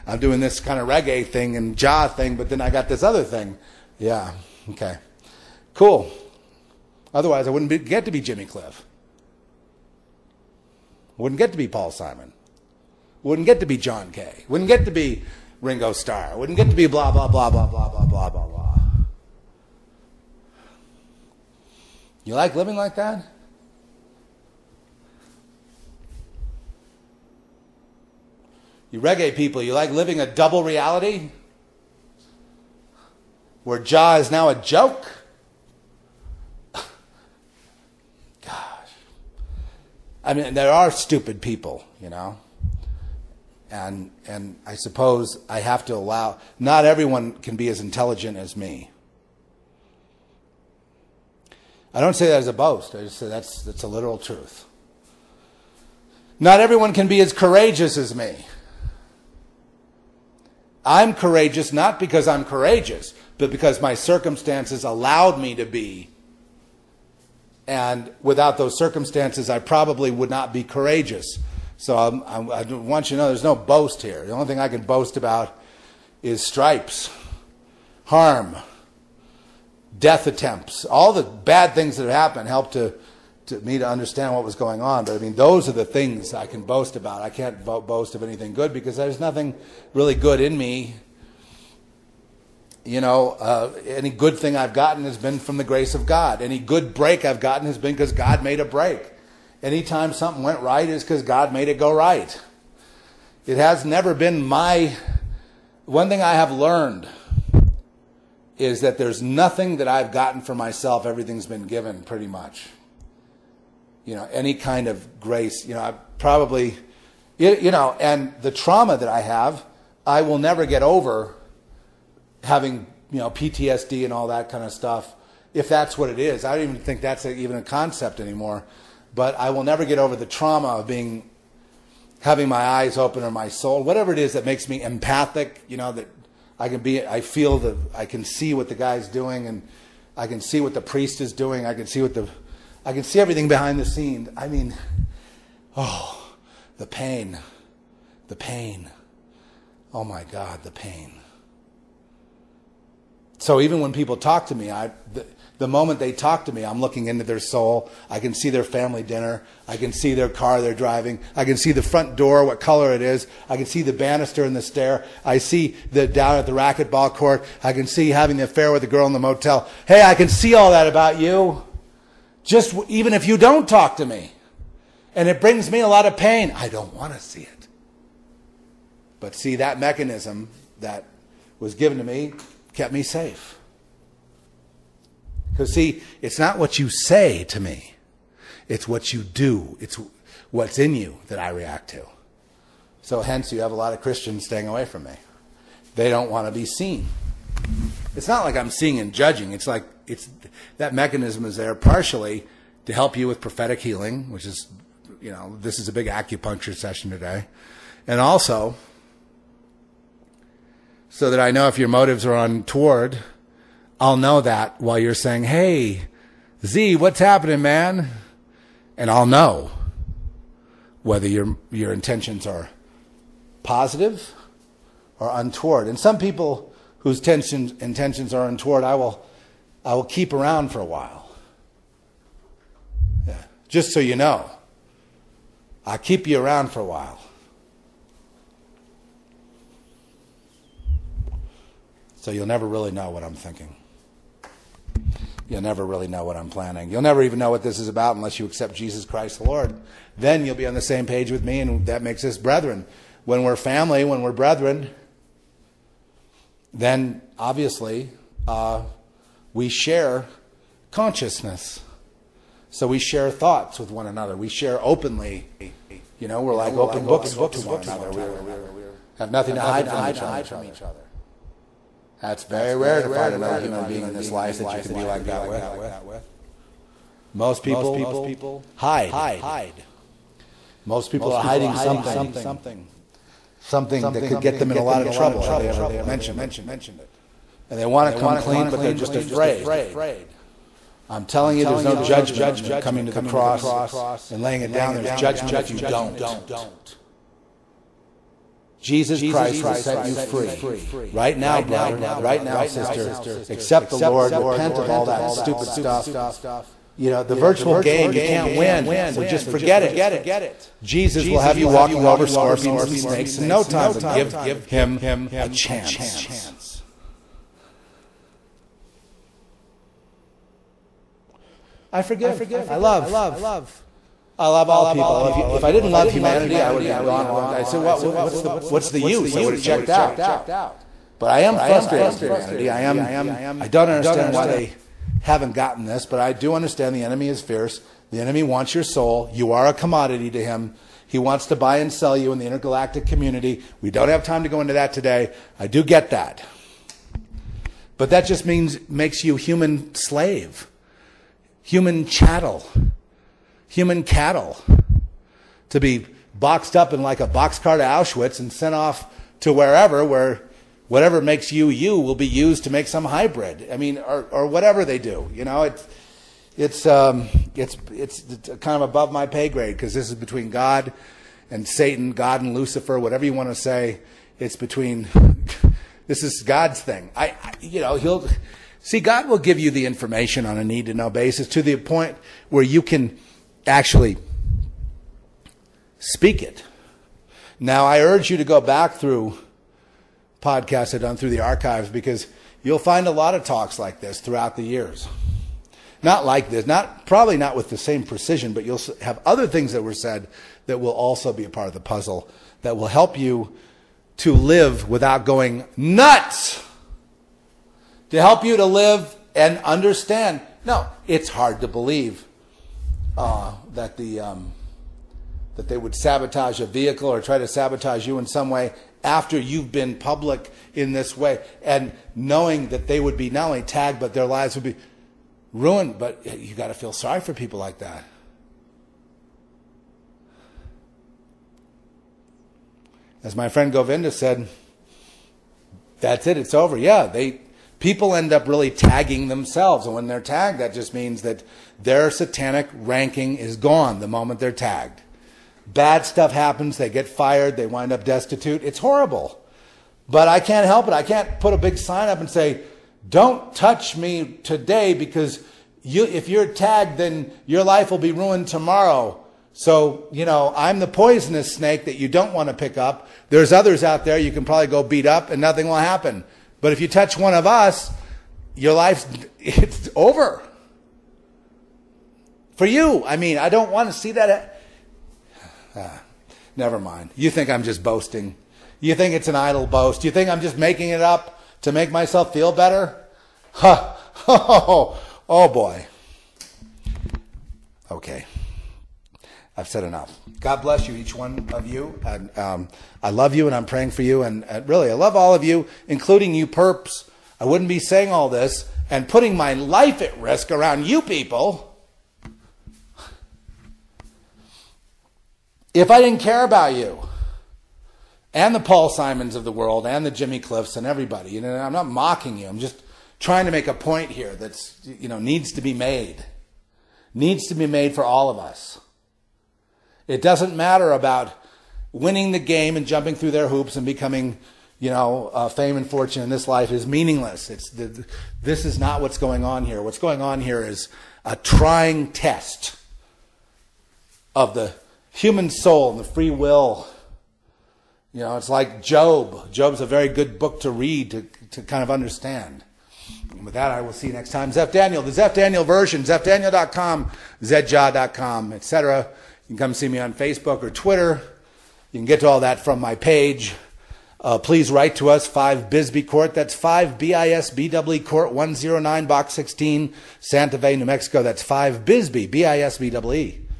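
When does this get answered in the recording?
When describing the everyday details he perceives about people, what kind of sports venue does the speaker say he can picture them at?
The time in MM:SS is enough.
02:46.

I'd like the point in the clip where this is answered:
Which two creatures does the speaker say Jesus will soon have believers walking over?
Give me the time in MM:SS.
05:12.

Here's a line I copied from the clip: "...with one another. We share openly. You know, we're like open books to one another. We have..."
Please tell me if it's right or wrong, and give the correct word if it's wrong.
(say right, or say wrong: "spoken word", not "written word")
right.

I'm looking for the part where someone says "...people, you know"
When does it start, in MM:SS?
00:41.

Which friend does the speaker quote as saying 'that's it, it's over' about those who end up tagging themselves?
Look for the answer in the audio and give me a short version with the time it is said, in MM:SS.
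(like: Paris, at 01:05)
Govinda, at 07:13.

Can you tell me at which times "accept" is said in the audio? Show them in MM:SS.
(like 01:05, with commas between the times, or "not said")
04:08, 05:03.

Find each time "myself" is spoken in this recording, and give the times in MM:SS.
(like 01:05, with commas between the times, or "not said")
01:50, 08:01.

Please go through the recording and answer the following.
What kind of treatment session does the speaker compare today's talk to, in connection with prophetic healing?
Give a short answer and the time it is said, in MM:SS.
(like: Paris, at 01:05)
acupuncture, at 03:26.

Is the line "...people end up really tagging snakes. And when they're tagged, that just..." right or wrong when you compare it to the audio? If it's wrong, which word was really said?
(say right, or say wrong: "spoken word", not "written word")
wrong: "themselves", not "snakes".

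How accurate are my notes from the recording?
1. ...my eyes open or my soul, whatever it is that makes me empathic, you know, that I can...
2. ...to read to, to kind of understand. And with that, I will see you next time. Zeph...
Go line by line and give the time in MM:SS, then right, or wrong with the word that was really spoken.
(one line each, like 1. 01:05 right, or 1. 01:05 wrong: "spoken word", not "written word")
1. 02:12 right
2. 09:00 right.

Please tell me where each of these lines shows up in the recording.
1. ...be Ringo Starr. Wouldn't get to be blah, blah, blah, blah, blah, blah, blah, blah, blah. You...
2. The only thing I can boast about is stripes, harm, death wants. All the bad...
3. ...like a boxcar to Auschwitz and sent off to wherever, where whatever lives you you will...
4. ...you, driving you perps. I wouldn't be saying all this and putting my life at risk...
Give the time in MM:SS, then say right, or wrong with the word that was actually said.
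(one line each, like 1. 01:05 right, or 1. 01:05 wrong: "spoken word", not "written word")
1. 00:14 right
2. 01:14 wrong: "attempts", not "wants"
3. 05:57 wrong: "makes", not "lives"
4. 08:15 wrong: "including", not "driving".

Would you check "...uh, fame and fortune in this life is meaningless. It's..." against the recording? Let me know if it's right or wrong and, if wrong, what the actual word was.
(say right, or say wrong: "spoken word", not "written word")
right.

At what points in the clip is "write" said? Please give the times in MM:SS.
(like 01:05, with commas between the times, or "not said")
09:14.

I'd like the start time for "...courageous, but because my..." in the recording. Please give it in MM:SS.
01:02.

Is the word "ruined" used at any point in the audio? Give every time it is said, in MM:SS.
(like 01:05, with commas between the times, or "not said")
07:05, 07:38.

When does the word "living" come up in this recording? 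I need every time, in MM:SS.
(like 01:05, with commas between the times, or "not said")
00:22, 00:29.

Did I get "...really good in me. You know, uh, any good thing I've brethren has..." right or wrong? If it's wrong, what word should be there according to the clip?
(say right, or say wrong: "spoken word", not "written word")
wrong: "gotten", not "brethren".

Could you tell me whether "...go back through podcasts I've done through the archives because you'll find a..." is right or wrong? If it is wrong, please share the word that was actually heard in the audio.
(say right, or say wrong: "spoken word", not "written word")
right.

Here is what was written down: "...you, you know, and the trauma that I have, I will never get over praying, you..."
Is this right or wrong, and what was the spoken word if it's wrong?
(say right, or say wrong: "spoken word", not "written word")
wrong: "having", not "praying".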